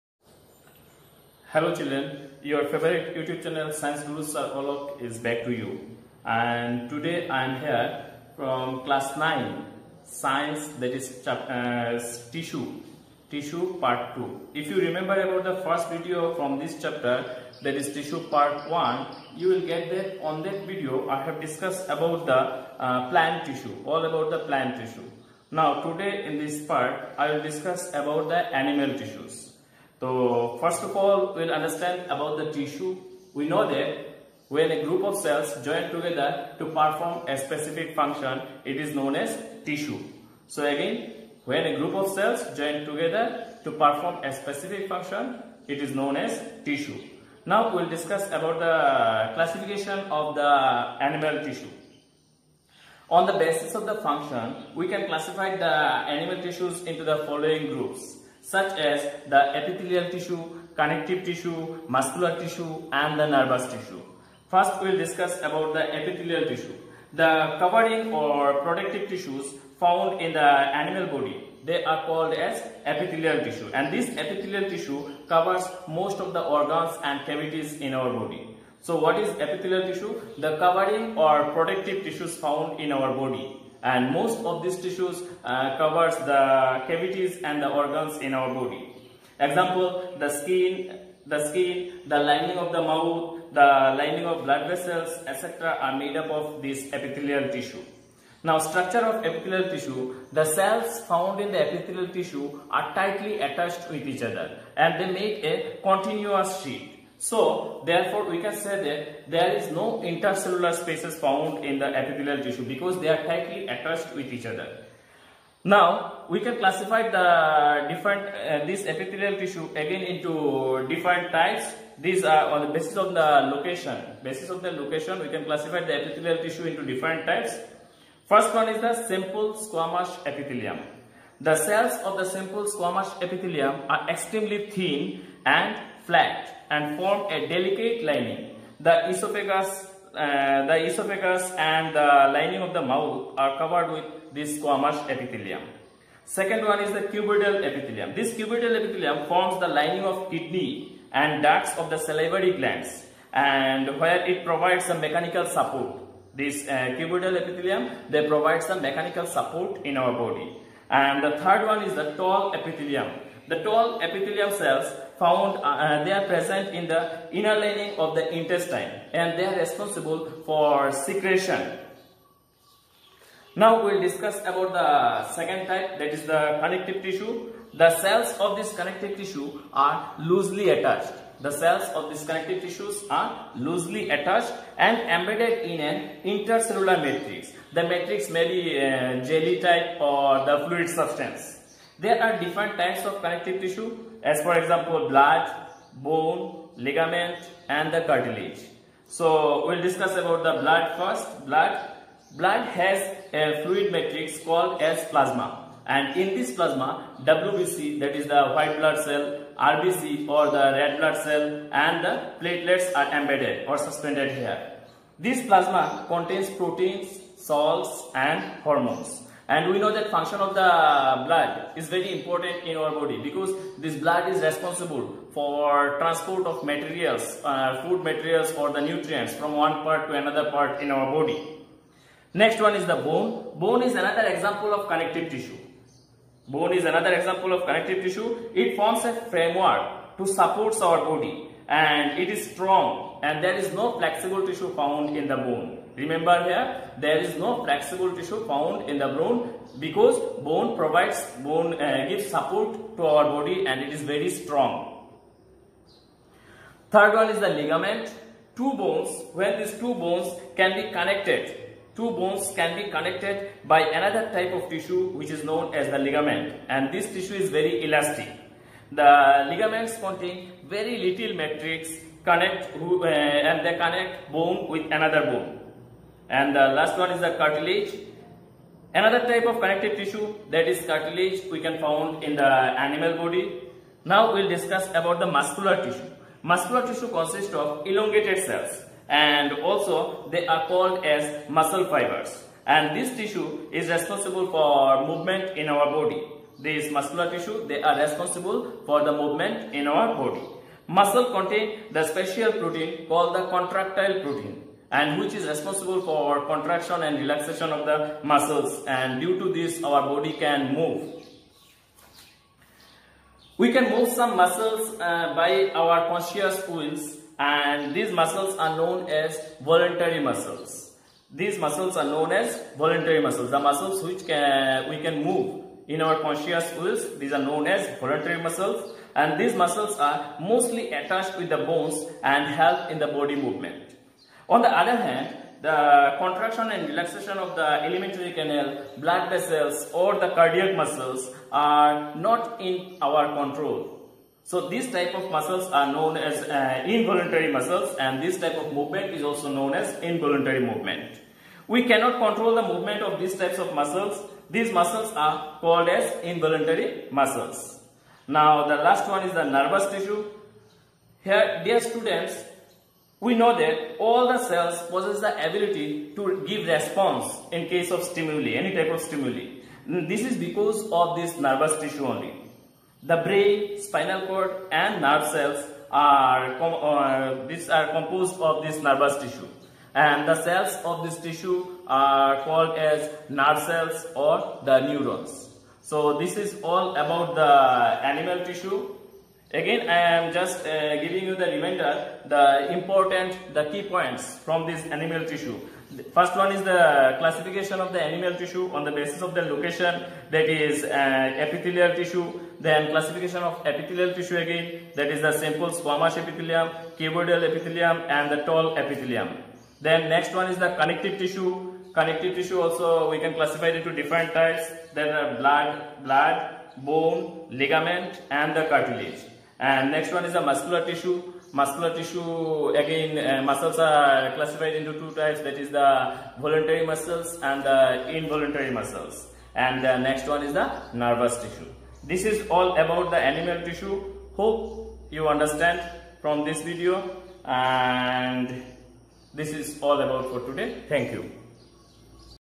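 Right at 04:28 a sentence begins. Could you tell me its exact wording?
The ligaments contain very little matrix connect uh, and they connect bone with another bone.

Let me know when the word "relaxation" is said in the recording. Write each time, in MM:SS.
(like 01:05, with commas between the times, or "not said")
05:07, 05:36.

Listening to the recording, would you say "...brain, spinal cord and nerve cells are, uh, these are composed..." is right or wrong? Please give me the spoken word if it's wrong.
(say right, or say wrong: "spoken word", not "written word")
right.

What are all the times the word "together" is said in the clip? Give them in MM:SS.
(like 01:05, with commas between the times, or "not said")
00:35, 00:42.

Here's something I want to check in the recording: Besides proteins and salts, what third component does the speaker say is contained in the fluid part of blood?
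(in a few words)
Hormones.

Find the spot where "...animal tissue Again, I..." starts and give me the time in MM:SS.
06:27.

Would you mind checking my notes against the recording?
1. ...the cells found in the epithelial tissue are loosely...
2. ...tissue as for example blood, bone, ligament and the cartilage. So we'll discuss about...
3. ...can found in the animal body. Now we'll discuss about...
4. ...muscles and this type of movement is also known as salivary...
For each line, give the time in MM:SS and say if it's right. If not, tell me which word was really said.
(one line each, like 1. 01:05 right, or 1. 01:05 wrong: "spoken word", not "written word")
1. 01:40 wrong: "tightly", not "loosely"
2. 03:13 right
3. 04:41 right
4. 05:47 wrong: "involuntary", not "salivary".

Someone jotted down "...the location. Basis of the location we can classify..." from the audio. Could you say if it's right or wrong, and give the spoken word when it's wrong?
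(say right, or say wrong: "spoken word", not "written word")
right.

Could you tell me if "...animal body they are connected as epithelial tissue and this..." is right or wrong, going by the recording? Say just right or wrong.
wrong.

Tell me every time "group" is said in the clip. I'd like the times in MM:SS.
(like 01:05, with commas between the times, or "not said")
00:34, 00:41, 00:57.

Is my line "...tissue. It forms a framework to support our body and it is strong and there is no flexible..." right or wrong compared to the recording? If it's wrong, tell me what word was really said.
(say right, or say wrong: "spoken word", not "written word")
right.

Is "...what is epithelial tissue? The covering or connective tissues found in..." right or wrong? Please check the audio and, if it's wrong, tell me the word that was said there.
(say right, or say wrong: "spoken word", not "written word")
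wrong: "protective", not "connective".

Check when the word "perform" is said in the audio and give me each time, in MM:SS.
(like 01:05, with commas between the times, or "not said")
00:36, 00:43.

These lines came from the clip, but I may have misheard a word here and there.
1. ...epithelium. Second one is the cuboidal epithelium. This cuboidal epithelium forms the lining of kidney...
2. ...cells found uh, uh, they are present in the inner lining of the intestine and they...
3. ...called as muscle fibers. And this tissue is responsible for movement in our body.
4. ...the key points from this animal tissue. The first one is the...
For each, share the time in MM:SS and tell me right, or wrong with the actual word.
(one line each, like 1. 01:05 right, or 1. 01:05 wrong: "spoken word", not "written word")
1. 02:25 right
2. 02:44 right
3. 04:50 right
4. 06:33 right.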